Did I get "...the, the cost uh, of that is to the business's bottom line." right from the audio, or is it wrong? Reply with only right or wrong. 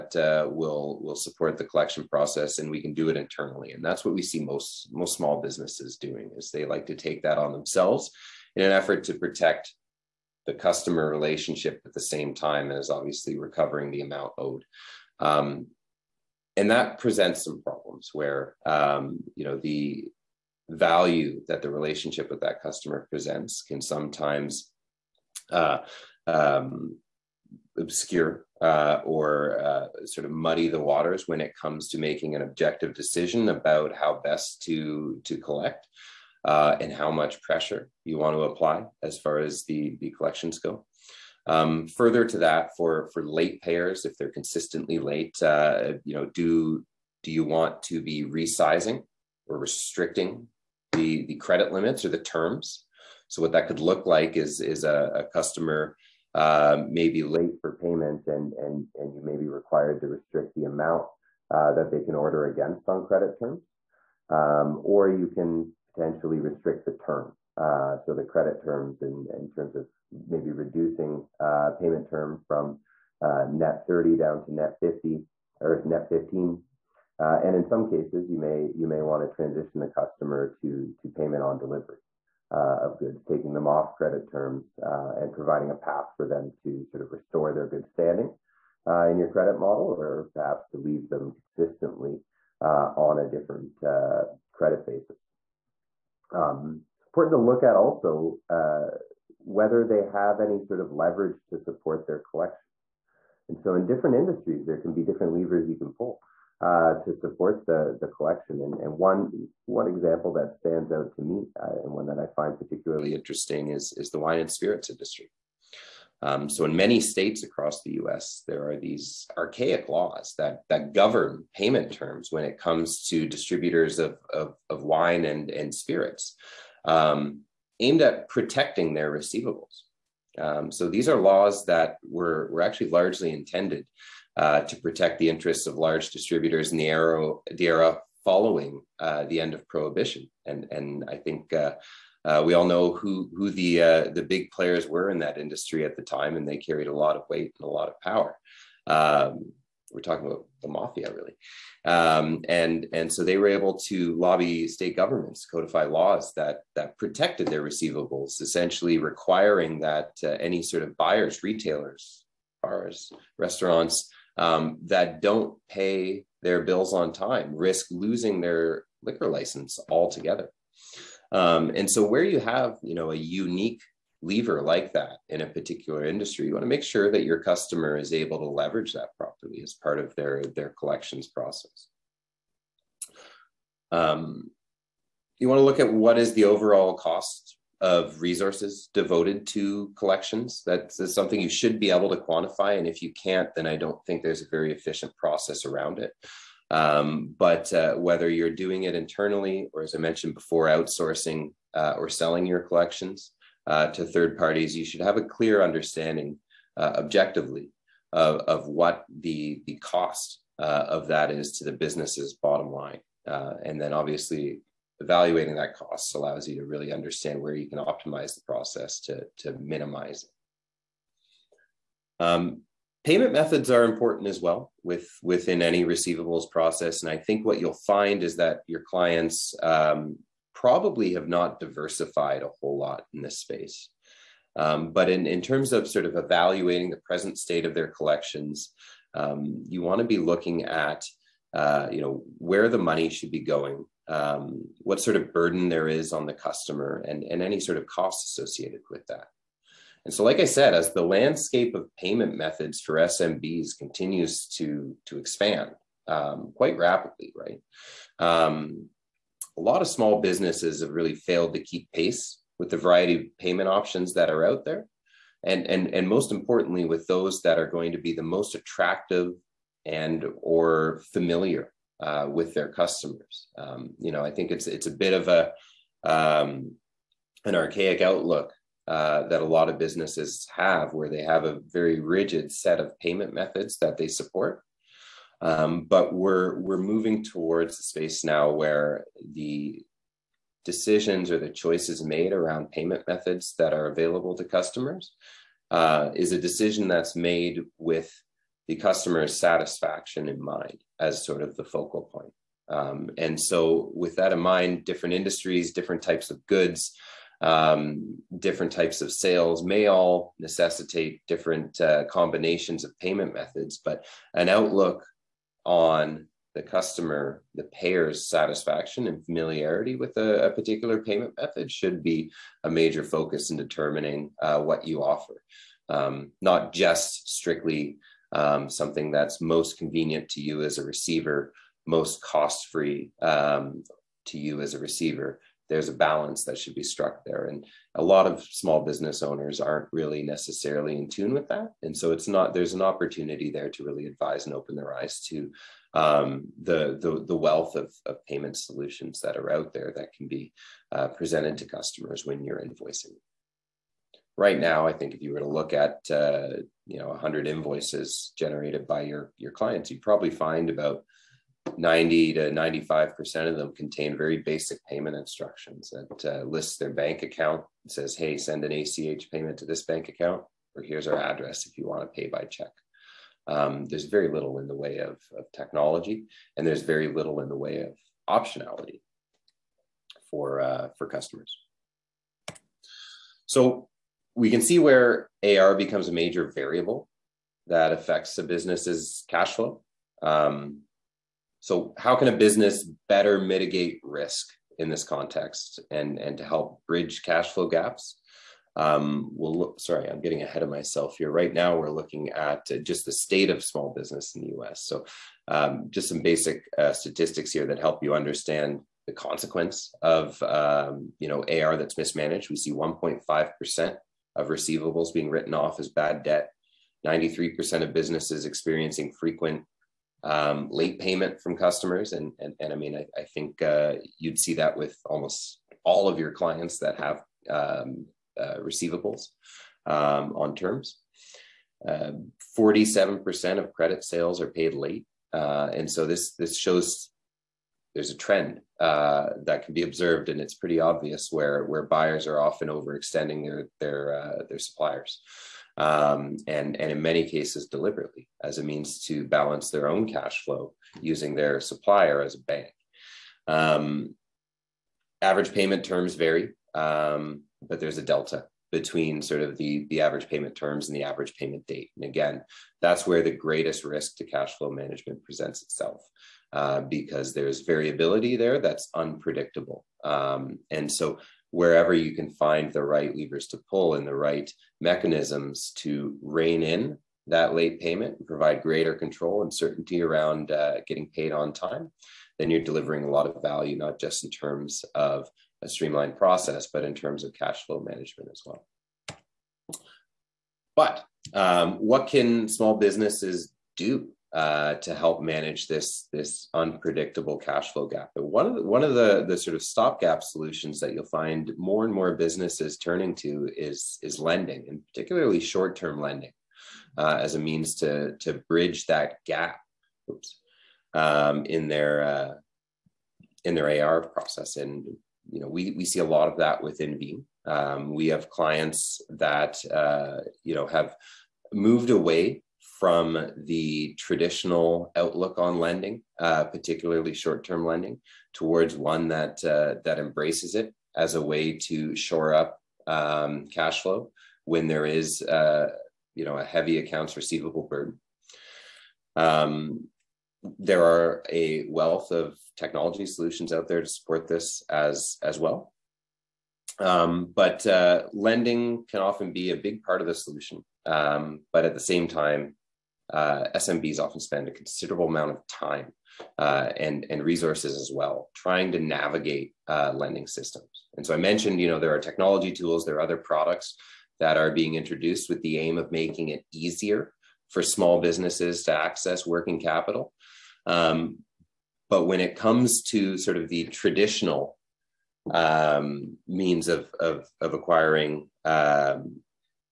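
right.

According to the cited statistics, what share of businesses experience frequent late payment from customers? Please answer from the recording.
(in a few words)
93%.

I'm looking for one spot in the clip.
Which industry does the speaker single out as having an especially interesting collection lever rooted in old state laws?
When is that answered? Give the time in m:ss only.
1:54.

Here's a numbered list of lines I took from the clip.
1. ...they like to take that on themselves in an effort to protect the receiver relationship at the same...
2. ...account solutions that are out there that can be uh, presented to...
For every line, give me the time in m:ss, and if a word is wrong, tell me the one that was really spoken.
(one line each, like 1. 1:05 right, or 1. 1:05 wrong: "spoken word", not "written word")
1. 0:06 wrong: "customer", not "receiver"
2. 5:48 wrong: "payment", not "account".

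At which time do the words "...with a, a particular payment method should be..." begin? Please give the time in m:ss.
5:19.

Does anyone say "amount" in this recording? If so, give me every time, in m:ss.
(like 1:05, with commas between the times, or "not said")
0:14, 1:00, 9:15.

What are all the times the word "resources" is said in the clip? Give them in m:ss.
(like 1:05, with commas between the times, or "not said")
3:08, 9:17.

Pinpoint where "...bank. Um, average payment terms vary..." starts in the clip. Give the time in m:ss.
7:32.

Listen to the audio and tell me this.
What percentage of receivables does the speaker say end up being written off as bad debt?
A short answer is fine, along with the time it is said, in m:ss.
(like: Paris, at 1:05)
1.5%, at 6:52.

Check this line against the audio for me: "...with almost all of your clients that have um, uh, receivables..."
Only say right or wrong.
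right.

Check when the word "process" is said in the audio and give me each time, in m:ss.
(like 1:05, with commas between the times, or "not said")
0:02, 3:01, 3:15, 3:38, 3:46, 8:06, 8:34.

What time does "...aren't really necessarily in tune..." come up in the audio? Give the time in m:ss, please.
5:39.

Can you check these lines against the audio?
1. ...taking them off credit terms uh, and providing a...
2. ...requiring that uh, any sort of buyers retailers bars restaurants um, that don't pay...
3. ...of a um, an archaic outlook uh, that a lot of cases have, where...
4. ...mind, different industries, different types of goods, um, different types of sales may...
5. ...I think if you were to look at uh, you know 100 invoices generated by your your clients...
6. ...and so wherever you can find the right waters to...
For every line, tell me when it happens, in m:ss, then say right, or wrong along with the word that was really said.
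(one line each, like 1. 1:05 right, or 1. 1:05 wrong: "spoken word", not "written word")
1. 1:23 right
2. 2:38 right
3. 4:35 wrong: "businesses", not "cases"
4. 5:04 right
5. 5:54 right
6. 7:50 wrong: "levers", not "waters".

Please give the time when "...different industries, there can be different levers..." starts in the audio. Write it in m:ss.
1:43.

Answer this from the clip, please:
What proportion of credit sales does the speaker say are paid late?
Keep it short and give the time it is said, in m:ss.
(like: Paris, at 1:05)
47%, at 7:12.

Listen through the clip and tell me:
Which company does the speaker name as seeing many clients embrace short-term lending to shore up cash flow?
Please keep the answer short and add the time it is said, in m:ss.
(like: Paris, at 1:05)
Veem, at 8:36.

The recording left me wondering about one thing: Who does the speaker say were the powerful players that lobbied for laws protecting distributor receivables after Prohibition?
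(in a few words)
the mafia.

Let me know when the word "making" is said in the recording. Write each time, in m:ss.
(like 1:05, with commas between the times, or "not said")
0:31, 9:25.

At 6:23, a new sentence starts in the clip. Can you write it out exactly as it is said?
So we can see where AR becomes a major variable that affects a business's cash flow.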